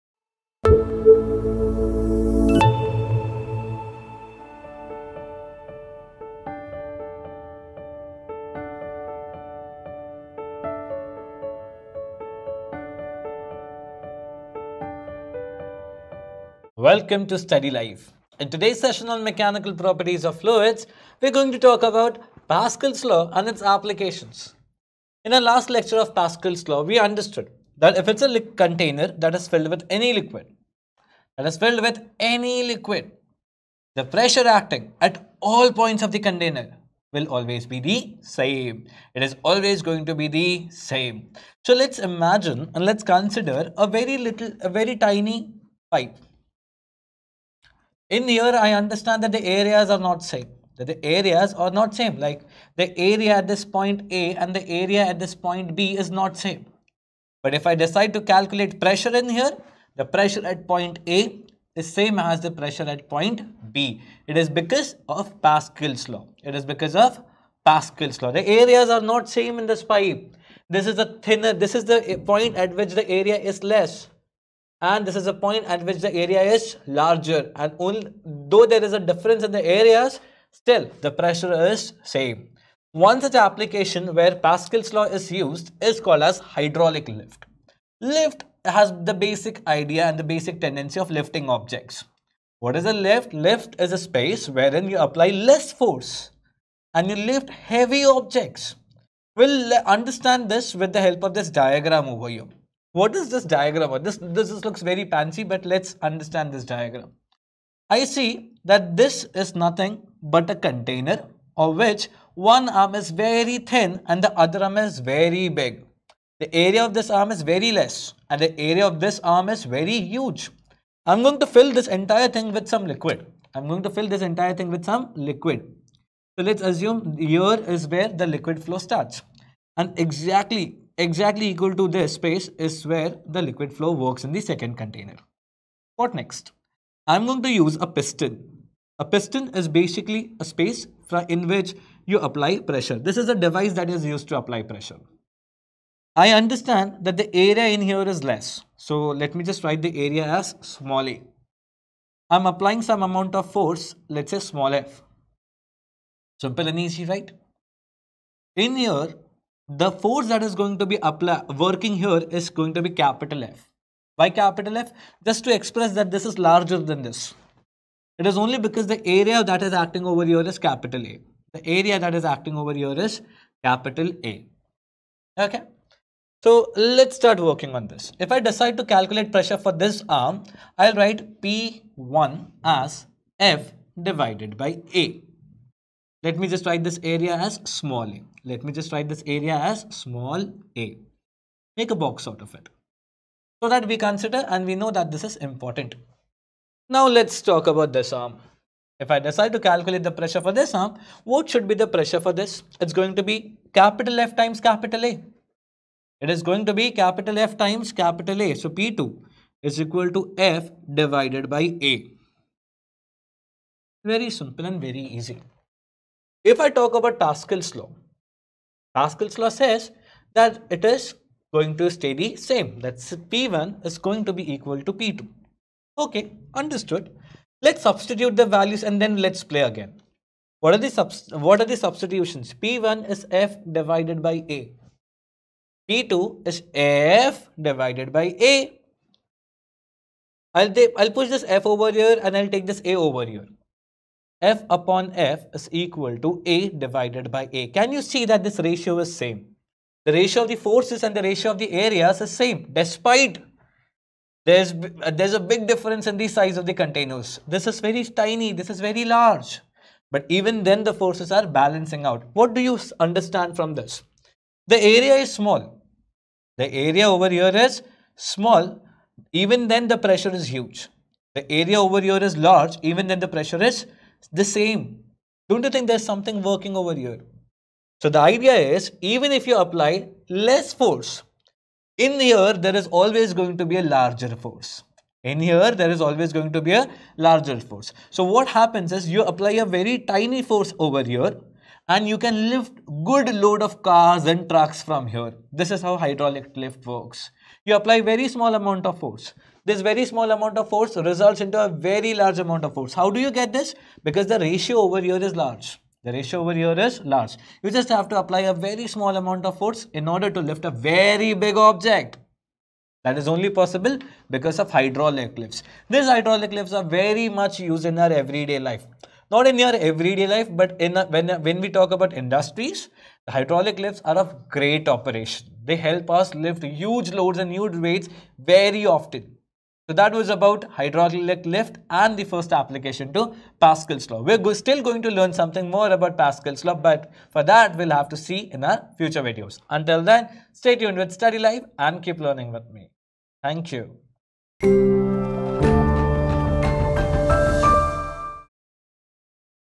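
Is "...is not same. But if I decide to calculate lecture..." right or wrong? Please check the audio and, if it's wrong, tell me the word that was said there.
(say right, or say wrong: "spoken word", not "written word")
wrong: "pressure", not "lecture".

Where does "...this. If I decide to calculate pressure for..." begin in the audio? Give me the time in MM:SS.
02:57.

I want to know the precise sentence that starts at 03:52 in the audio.
P1 is F divided by A p 2 is F divided by A.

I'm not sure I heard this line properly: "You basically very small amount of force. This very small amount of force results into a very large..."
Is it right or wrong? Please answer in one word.
wrong.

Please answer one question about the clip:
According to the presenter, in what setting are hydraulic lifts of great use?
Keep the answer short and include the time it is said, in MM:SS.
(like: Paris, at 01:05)
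industries, at 05:22.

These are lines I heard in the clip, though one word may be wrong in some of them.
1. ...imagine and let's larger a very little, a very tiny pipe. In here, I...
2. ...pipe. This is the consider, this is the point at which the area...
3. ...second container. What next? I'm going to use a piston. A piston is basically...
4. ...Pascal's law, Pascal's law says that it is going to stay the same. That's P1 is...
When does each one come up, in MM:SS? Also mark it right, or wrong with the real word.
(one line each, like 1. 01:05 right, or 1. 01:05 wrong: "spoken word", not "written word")
1. 00:41 wrong: "consider", not "larger"
2. 01:09 wrong: "thinner", not "consider"
3. 02:14 right
4. 03:37 right.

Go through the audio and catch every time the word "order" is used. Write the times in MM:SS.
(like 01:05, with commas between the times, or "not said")
05:10.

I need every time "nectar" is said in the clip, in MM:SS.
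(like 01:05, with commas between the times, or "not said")
not said.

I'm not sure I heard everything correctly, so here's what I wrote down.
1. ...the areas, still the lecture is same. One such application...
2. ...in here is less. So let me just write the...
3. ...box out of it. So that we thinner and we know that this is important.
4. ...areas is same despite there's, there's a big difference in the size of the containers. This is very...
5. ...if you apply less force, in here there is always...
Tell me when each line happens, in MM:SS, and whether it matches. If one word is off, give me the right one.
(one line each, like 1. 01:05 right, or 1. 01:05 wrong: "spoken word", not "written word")
1. 01:19 wrong: "pressure", not "lecture"
2. 02:27 right
3. 03:11 wrong: "consider", not "thinner"
4. 04:11 right
5. 04:39 right.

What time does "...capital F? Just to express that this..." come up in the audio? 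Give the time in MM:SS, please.
02:44.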